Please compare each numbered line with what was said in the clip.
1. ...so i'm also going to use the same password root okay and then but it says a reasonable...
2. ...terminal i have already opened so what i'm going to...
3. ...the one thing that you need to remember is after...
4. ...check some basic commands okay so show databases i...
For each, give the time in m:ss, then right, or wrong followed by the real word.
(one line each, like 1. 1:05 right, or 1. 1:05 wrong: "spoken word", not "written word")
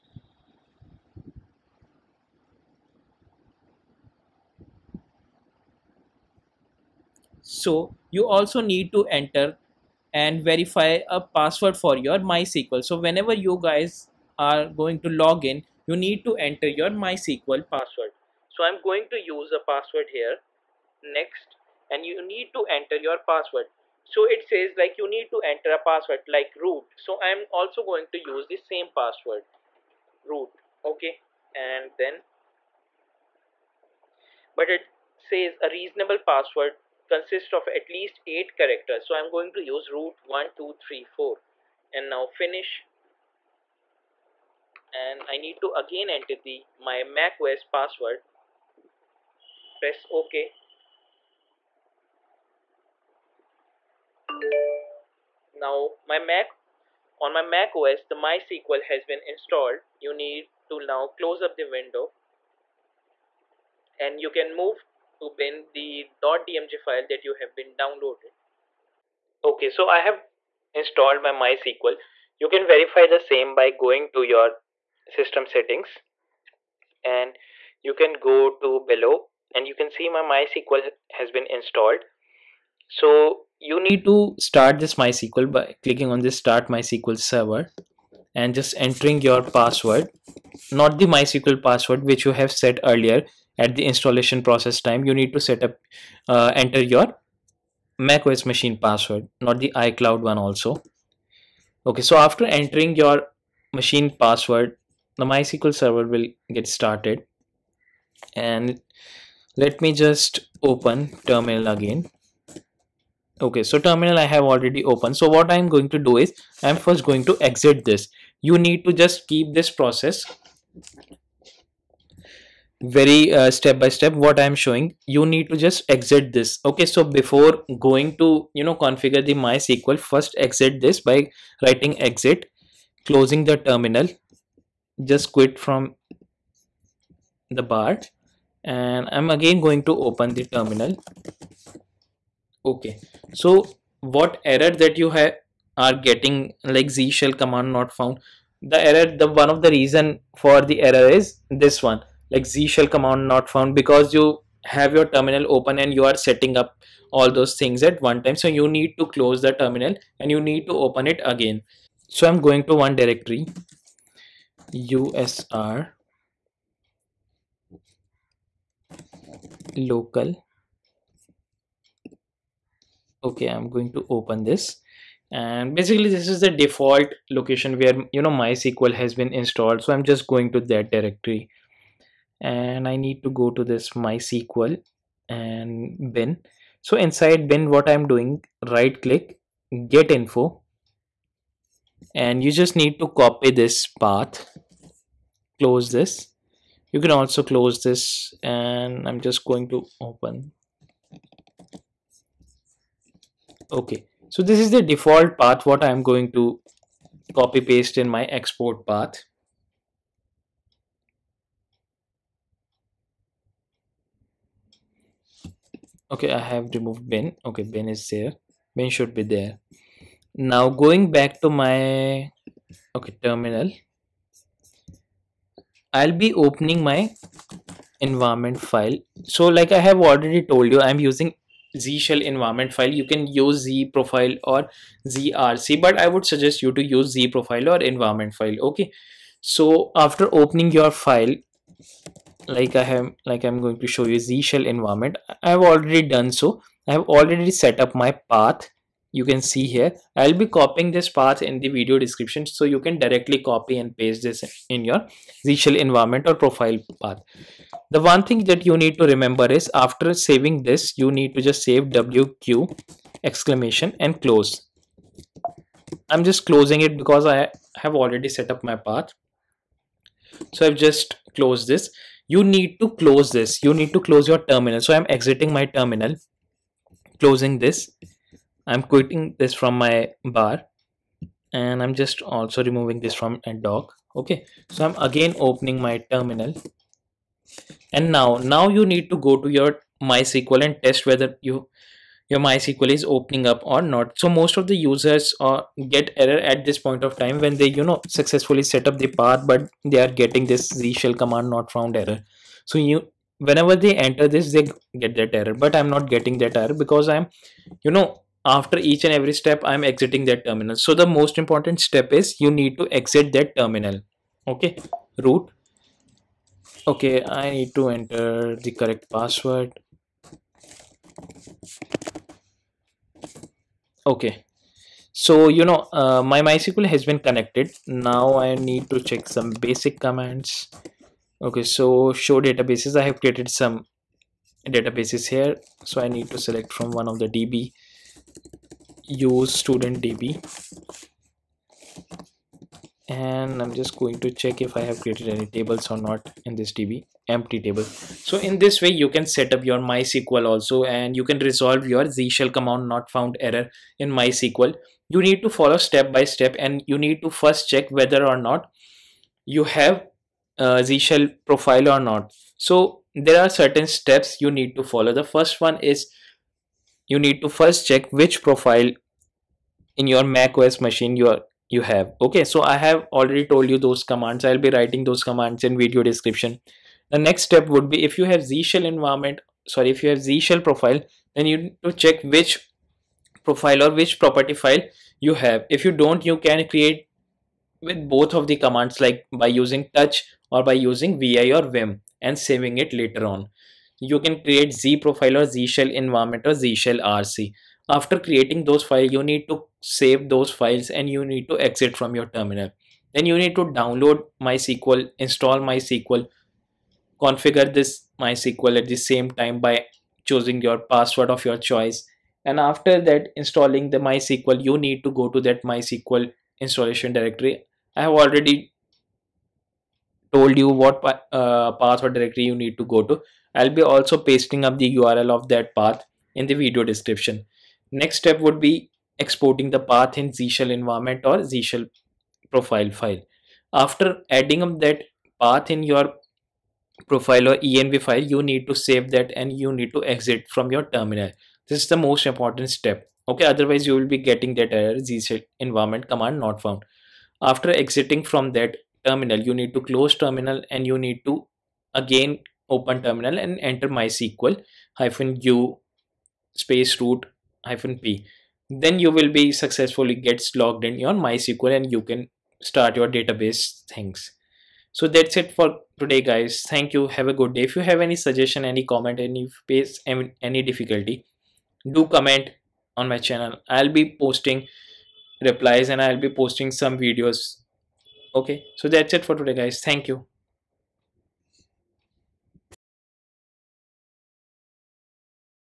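1. 0:26 right
2. 1:53 right
3. 4:17 right
4. 5:28 right.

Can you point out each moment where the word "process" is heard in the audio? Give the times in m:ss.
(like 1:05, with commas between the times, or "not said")
1:34, 1:59.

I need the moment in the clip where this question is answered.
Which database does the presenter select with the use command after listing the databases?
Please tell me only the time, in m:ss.
5:39.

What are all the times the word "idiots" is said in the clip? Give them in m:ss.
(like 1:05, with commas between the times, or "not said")
not said.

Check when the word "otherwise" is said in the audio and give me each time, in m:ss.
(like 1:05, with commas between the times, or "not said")
7:23.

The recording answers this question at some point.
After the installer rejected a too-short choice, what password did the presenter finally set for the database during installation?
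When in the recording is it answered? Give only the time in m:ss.
0:39.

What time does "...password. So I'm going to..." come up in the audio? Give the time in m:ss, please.
0:17.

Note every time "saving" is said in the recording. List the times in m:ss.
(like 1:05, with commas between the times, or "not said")
4:20, 6:32.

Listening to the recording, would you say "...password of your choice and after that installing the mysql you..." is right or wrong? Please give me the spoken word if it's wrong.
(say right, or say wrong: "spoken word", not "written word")
right.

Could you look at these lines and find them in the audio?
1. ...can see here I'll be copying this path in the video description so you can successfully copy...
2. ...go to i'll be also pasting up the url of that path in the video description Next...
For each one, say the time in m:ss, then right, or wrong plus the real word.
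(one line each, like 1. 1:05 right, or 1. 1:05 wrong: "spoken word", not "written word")
1. 4:09 wrong: "directly", not "successfully"
2. 7:02 right.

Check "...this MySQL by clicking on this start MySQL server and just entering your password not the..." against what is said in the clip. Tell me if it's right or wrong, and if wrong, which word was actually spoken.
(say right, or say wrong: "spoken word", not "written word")
right.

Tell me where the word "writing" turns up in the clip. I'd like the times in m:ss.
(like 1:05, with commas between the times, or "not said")
2:11, 6:14.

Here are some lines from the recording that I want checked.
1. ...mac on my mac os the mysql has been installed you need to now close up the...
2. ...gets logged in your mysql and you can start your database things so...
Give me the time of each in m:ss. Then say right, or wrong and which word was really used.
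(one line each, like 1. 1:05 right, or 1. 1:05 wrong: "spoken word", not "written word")
1. 0:56 right
2. 7:40 right.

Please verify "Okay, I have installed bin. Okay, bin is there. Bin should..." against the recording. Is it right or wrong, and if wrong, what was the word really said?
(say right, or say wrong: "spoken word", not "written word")
wrong: "removed", not "installed".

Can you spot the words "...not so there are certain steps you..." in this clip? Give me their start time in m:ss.
6:02.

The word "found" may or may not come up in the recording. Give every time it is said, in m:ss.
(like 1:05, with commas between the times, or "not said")
2:27, 2:33, 5:01, 5:53, 7:26.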